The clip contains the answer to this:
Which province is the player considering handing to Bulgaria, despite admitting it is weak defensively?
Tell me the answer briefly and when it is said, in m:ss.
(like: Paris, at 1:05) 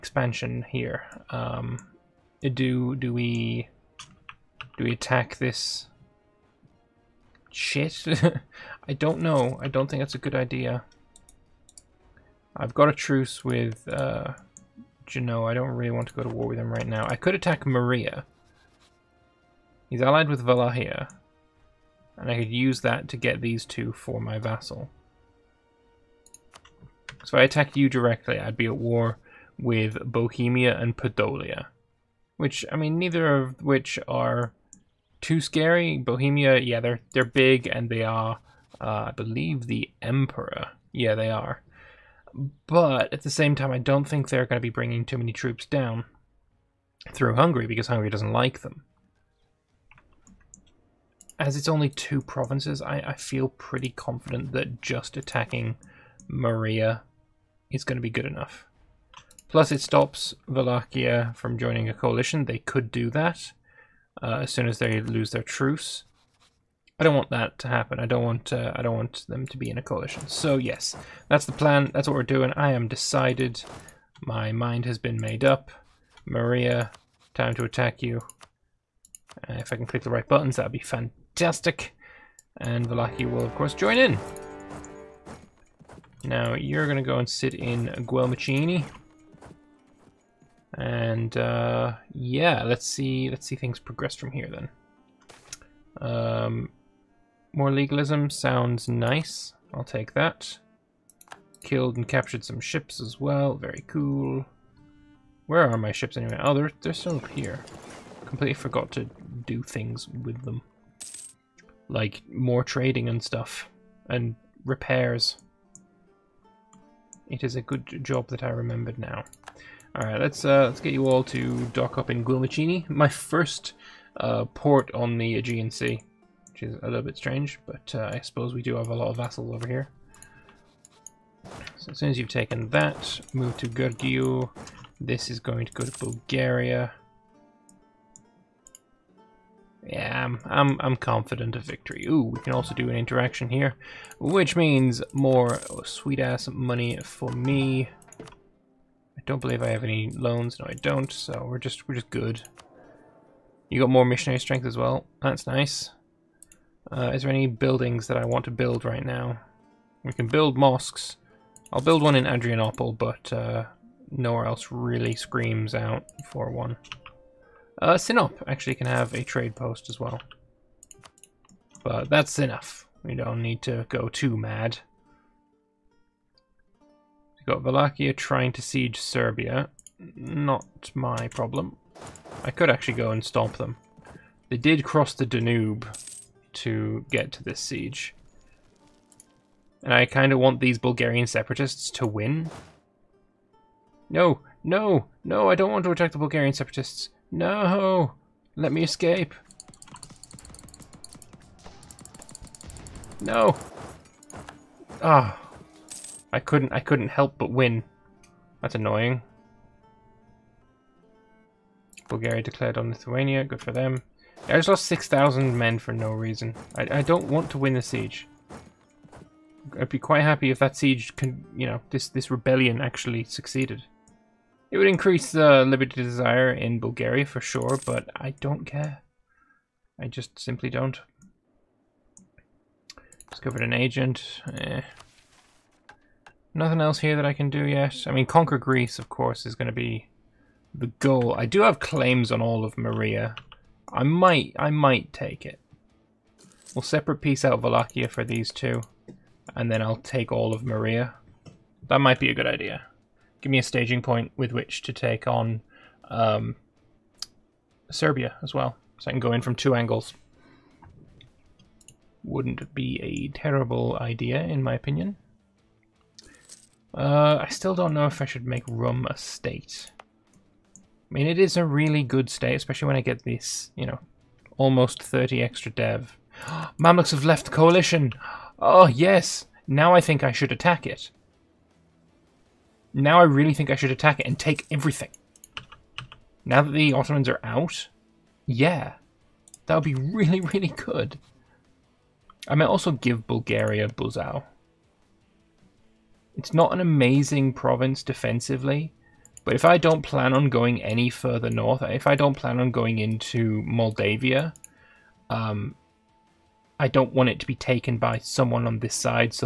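Buzau, at 4:53.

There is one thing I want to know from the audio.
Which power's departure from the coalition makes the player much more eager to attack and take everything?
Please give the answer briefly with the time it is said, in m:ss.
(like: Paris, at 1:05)
Mamluks, at 4:36.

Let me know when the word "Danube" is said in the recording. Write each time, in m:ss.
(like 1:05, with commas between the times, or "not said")
3:05.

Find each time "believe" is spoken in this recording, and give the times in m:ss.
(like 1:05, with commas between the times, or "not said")
0:39, 2:29.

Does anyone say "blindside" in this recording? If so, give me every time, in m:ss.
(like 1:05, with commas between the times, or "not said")
not said.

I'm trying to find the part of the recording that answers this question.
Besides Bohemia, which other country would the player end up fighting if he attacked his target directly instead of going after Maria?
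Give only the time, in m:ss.
0:30.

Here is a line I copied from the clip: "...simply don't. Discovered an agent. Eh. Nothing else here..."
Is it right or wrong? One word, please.
right.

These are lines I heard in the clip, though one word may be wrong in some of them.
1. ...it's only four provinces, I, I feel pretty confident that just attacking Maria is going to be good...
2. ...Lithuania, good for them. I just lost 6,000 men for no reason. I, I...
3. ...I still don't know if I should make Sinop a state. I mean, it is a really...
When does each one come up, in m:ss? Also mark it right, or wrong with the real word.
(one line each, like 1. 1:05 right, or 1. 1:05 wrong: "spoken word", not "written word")
1. 0:51 wrong: "two", not "four"
2. 3:32 right
3. 4:27 wrong: "Rum", not "Sinop".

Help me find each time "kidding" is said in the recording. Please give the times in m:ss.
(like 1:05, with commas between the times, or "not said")
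not said.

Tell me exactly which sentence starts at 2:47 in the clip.
Uh, Sinop actually can have a trade post as well.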